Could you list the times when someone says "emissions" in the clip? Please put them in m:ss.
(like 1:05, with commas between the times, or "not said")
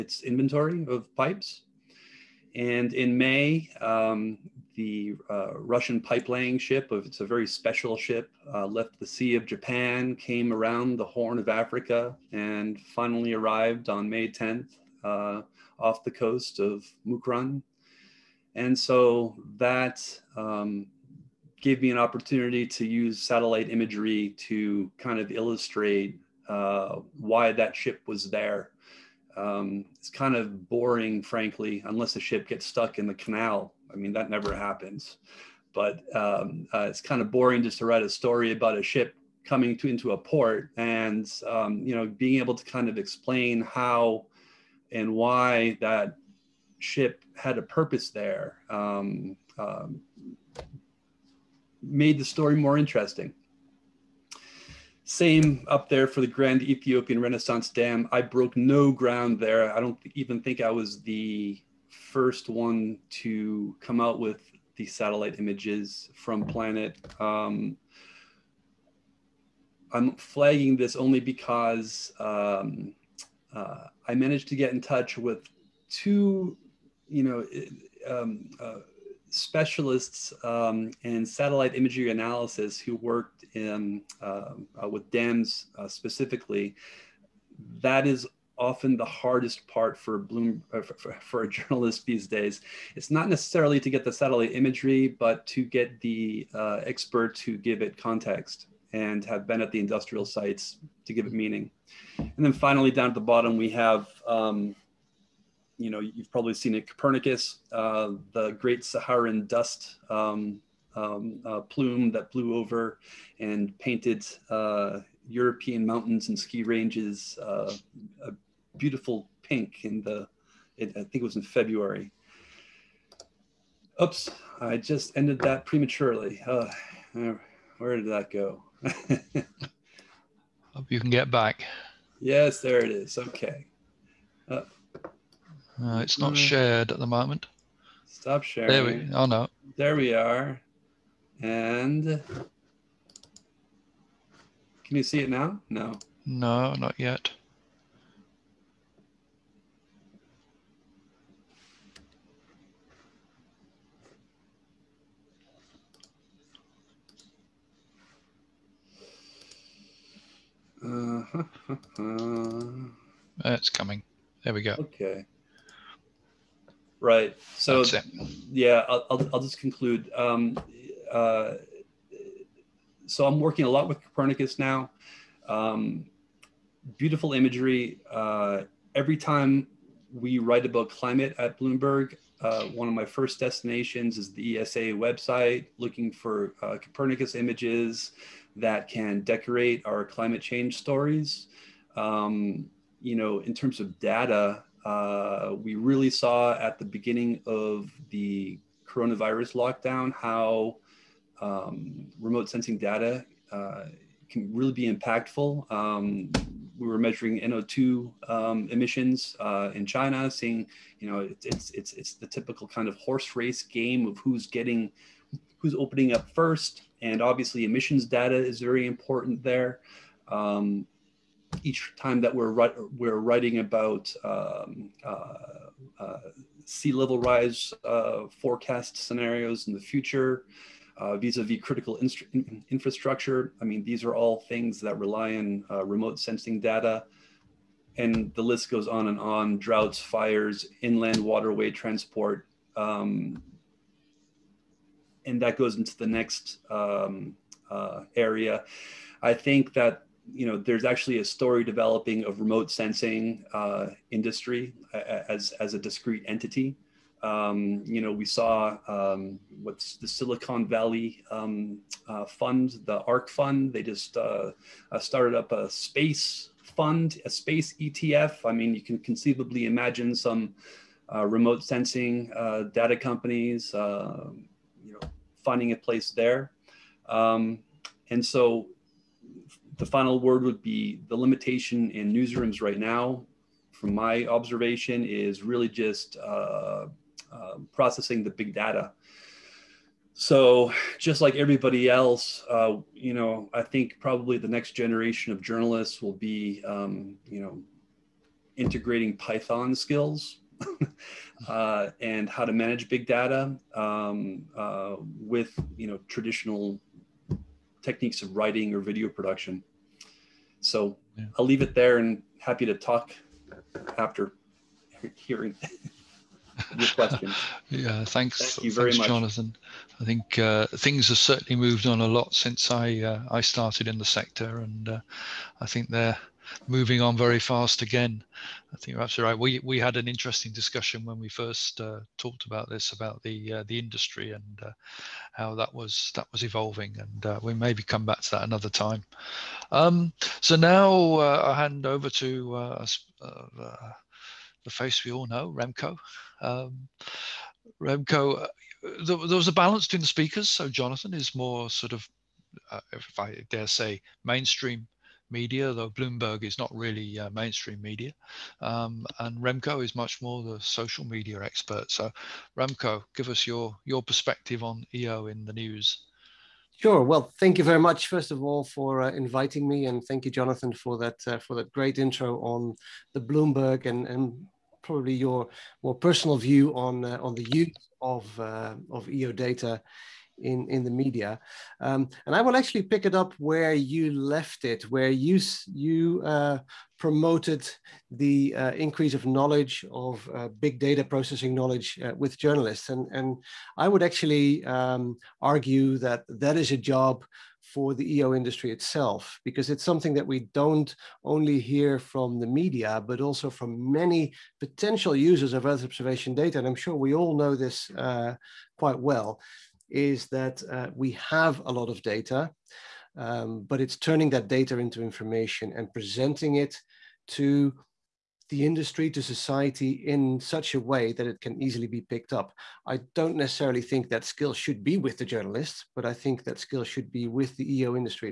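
3:28, 3:37.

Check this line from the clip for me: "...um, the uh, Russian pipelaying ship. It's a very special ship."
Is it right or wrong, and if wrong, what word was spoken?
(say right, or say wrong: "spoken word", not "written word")
right.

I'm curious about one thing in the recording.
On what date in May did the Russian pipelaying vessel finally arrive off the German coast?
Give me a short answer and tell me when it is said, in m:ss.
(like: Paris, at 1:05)
May 10th, at 0:14.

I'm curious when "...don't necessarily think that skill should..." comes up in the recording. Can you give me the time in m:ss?
7:03.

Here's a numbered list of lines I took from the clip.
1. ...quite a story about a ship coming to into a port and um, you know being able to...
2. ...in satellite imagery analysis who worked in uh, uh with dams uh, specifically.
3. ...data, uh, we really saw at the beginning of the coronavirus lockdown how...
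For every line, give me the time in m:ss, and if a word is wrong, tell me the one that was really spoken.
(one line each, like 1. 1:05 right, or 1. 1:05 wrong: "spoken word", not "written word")
1. 0:37 wrong: "write", not "quite"
2. 1:21 right
3. 3:13 right.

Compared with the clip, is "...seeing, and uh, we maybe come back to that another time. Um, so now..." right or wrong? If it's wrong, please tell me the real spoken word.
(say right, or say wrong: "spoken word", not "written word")
wrong: "evolving", not "seeing".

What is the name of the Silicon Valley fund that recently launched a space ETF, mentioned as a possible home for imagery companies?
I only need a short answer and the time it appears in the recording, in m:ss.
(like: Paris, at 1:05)
ARK fund, at 4:23.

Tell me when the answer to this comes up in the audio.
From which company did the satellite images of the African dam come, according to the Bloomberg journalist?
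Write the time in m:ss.
1:06.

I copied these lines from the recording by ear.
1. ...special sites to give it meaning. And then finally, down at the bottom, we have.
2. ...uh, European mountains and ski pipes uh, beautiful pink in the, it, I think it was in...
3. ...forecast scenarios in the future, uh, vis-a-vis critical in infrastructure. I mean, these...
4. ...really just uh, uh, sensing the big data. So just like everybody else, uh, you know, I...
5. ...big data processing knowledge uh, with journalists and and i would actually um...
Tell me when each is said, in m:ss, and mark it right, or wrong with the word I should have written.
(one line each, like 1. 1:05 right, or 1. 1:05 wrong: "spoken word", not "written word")
1. 1:39 wrong: "industrial", not "special"
2. 1:54 wrong: "ranges", not "pipes"
3. 3:48 right
4. 4:45 wrong: "processing", not "sensing"
5. 6:30 right.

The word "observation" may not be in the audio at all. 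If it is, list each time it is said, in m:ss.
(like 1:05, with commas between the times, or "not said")
4:44, 6:45.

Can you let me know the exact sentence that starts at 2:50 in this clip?
Um, uh, so I'm working a lot with Copernicus now.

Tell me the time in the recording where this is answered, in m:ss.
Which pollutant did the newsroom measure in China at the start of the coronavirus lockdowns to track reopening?
3:27.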